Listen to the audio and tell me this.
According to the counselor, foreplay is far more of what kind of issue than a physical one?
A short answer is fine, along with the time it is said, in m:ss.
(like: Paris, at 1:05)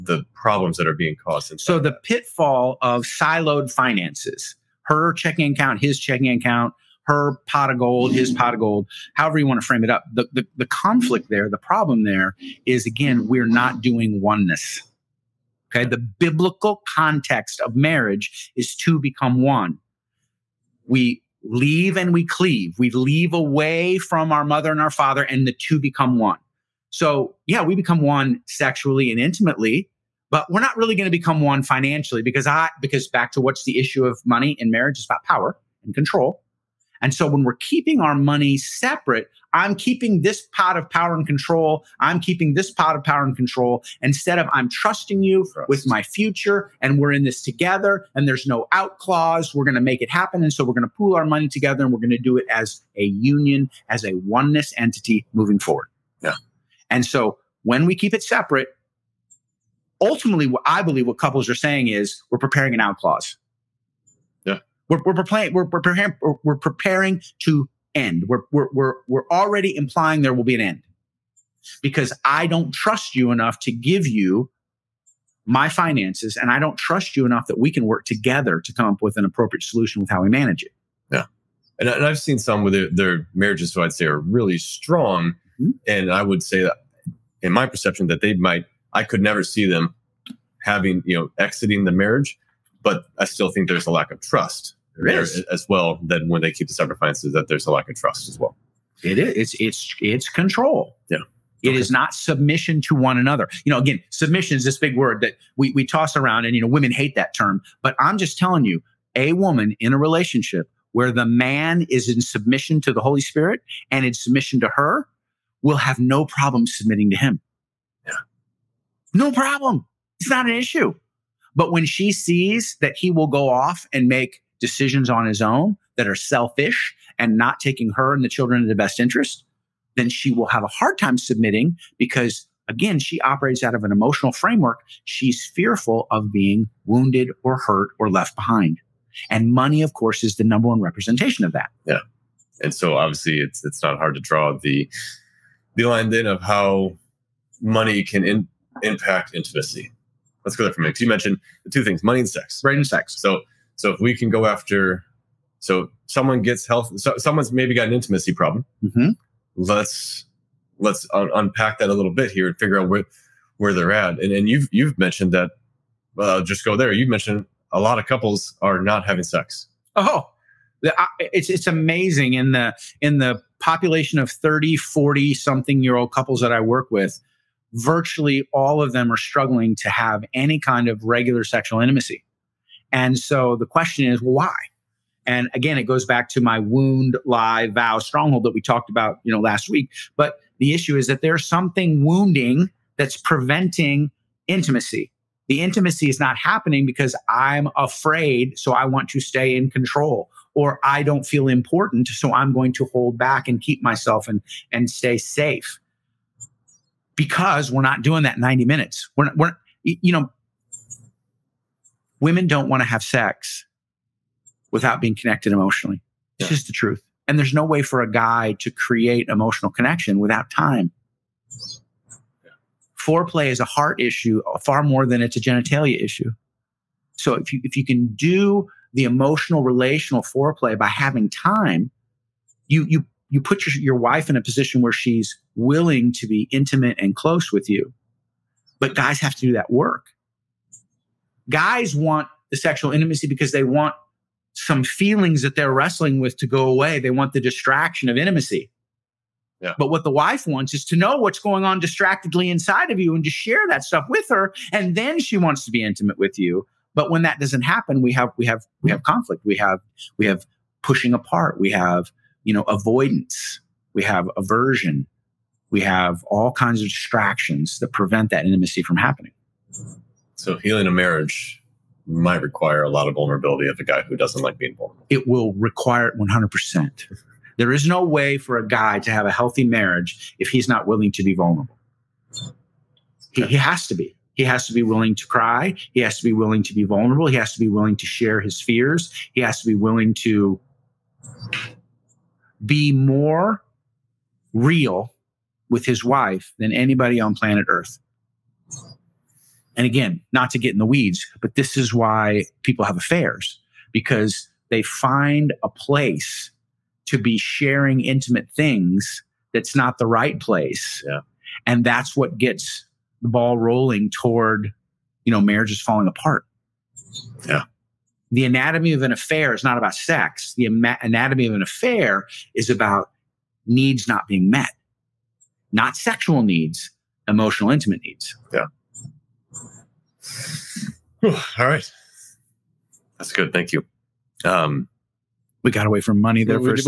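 a heart issue, at 3:43.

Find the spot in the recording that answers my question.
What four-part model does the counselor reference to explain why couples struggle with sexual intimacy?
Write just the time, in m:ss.
3:06.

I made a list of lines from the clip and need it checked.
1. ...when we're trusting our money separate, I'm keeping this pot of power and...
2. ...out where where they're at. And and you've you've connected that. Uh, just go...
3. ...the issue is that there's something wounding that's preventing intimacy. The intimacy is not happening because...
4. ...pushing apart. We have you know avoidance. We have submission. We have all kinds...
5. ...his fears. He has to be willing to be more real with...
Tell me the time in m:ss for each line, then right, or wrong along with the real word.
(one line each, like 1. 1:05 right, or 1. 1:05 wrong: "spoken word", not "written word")
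1. 0:37 wrong: "keeping", not "trusting"
2. 2:42 wrong: "mentioned", not "connected"
3. 3:10 right
4. 4:20 wrong: "aversion", not "submission"
5. 4:48 right.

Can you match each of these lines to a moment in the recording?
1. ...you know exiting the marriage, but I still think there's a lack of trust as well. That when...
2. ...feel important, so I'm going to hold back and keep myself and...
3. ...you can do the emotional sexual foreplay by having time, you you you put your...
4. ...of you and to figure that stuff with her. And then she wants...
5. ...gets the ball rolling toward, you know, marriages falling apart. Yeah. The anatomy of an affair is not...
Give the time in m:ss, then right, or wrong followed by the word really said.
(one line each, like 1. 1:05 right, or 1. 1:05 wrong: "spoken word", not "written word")
1. 1:31 right
2. 3:21 right
3. 3:47 wrong: "relational", not "sexual"
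4. 4:12 wrong: "share", not "figure"
5. 5:12 right.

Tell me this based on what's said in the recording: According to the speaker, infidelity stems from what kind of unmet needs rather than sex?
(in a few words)
emotional, intimate needs.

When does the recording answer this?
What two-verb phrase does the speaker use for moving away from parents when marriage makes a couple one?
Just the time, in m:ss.
0:21.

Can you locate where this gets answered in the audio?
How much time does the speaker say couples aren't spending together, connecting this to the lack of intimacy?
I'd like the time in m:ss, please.
3:28.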